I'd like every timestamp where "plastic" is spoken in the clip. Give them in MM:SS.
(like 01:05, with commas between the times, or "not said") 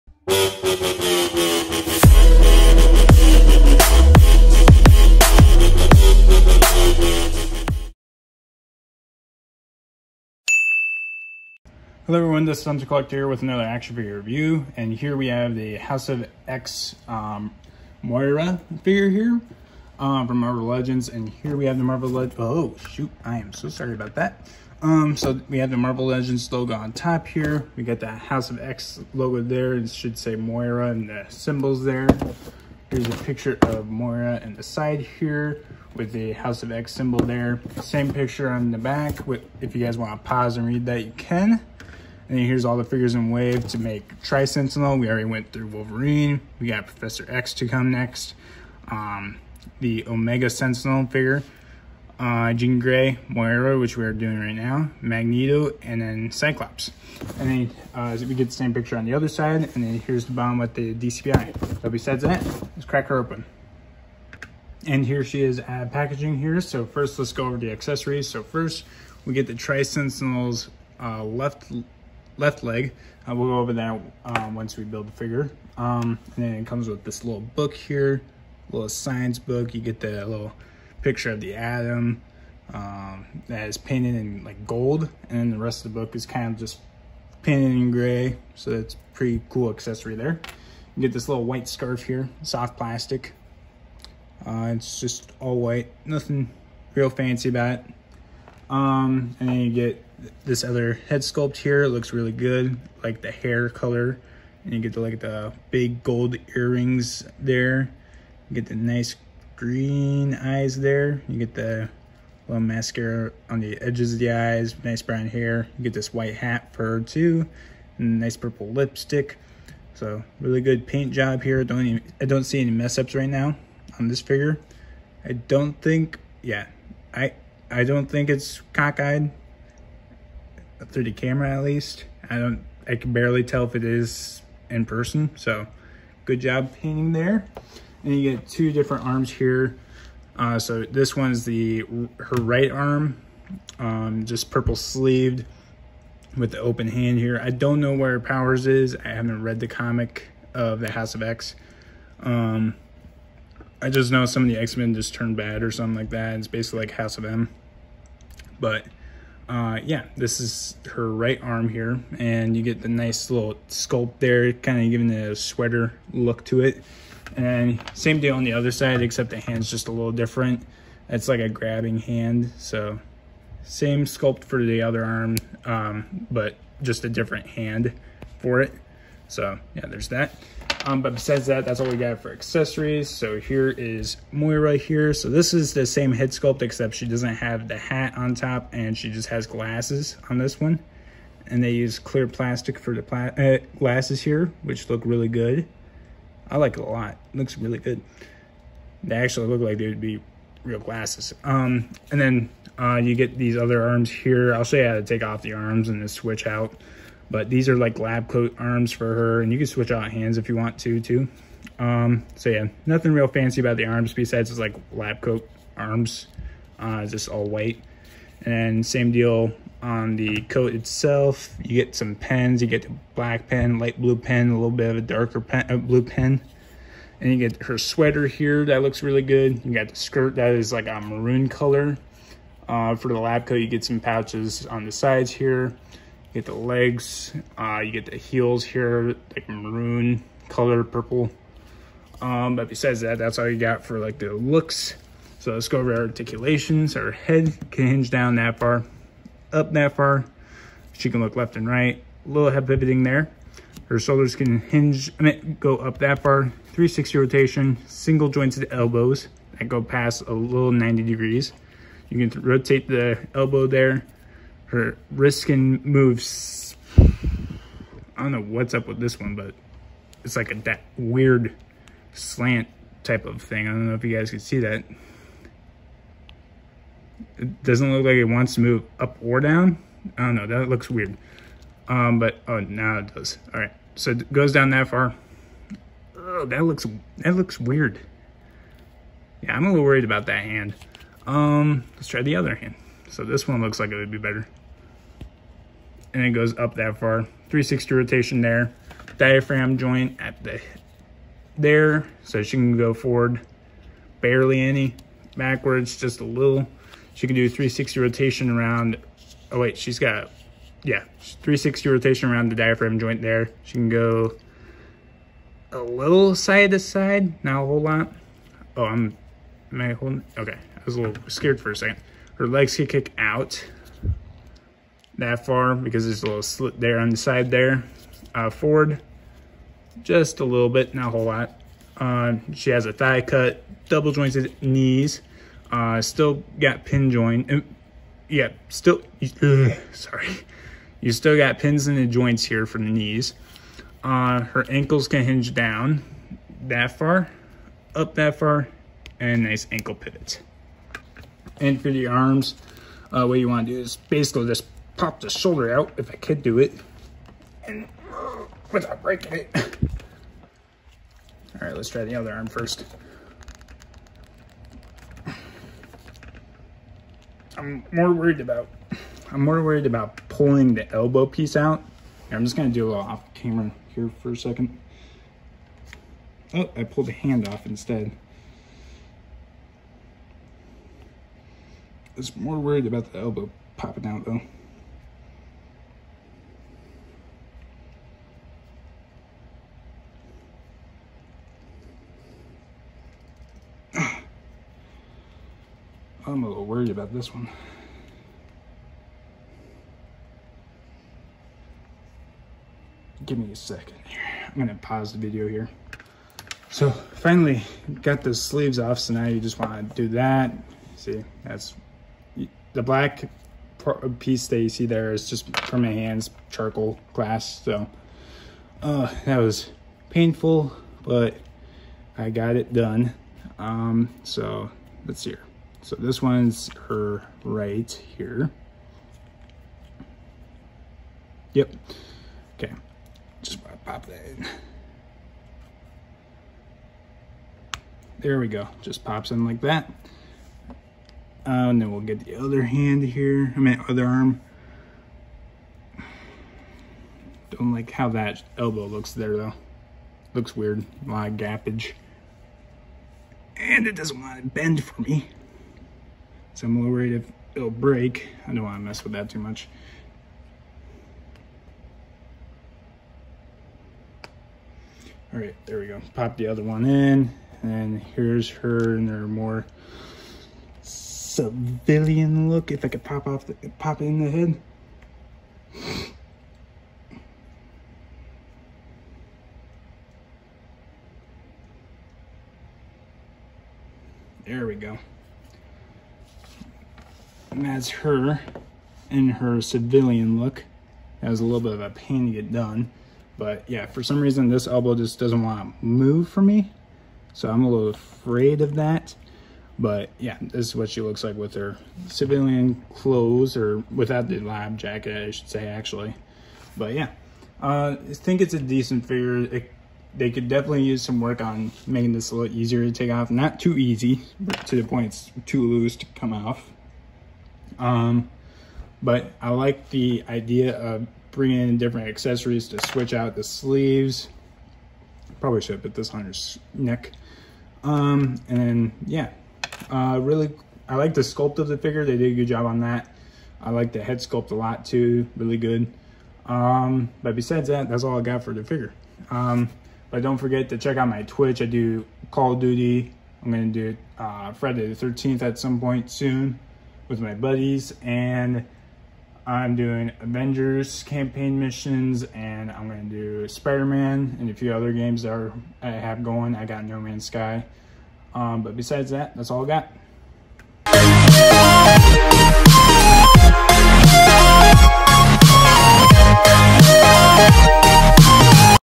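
01:32, 03:12.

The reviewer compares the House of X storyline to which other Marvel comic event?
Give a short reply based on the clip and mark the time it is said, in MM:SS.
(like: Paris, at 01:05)
House of M, at 02:36.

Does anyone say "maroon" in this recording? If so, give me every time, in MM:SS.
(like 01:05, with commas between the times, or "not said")
03:50, 03:59.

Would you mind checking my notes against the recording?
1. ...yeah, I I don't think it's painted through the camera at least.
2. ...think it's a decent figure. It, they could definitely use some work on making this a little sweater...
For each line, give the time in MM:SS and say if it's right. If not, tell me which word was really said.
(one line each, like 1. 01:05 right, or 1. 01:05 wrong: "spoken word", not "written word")
1. 02:06 wrong: "cockeyed", not "painted"
2. 08:28 wrong: "easier", not "sweater".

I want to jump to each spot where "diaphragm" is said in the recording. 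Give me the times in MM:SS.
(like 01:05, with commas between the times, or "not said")
04:59, 05:12.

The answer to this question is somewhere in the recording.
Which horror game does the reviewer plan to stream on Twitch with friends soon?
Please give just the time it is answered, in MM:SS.
09:04.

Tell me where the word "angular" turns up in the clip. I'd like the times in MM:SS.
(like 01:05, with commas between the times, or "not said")
not said.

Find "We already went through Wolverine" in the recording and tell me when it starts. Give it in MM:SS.
00:44.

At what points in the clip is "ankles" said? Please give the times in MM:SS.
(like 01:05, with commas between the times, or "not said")
05:44, 05:49.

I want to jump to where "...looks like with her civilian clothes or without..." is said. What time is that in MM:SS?
08:21.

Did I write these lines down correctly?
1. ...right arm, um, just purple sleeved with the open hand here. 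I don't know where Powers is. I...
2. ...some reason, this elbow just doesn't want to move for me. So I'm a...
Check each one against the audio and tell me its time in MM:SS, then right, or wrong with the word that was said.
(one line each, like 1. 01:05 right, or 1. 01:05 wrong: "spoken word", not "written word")
1. 02:22 right
2. 08:14 right.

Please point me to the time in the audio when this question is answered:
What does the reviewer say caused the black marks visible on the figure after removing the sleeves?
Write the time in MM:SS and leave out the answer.
06:56.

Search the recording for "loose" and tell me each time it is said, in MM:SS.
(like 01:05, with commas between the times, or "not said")
08:35.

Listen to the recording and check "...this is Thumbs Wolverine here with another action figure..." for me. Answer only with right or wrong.
wrong.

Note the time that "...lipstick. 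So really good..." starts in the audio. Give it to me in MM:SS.
01:58.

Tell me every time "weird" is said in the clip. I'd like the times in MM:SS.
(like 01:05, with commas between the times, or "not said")
04:30, 04:40, 04:47, 07:30.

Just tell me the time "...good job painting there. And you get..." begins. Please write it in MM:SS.
02:16.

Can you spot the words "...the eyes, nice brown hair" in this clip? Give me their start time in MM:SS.
01:54.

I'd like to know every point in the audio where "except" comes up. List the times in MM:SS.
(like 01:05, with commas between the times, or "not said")
02:49, 03:06.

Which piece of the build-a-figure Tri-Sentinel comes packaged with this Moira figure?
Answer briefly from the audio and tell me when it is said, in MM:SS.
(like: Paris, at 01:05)
Left leg, at 01:12.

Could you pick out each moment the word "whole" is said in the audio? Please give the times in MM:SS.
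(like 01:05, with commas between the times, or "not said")
05:17, 05:31.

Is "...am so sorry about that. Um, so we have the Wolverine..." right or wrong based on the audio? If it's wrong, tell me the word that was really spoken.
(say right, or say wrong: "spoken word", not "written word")
wrong: "Marvel", not "Wolverine".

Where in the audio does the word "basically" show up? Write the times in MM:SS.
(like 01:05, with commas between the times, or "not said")
02:36, 05:54.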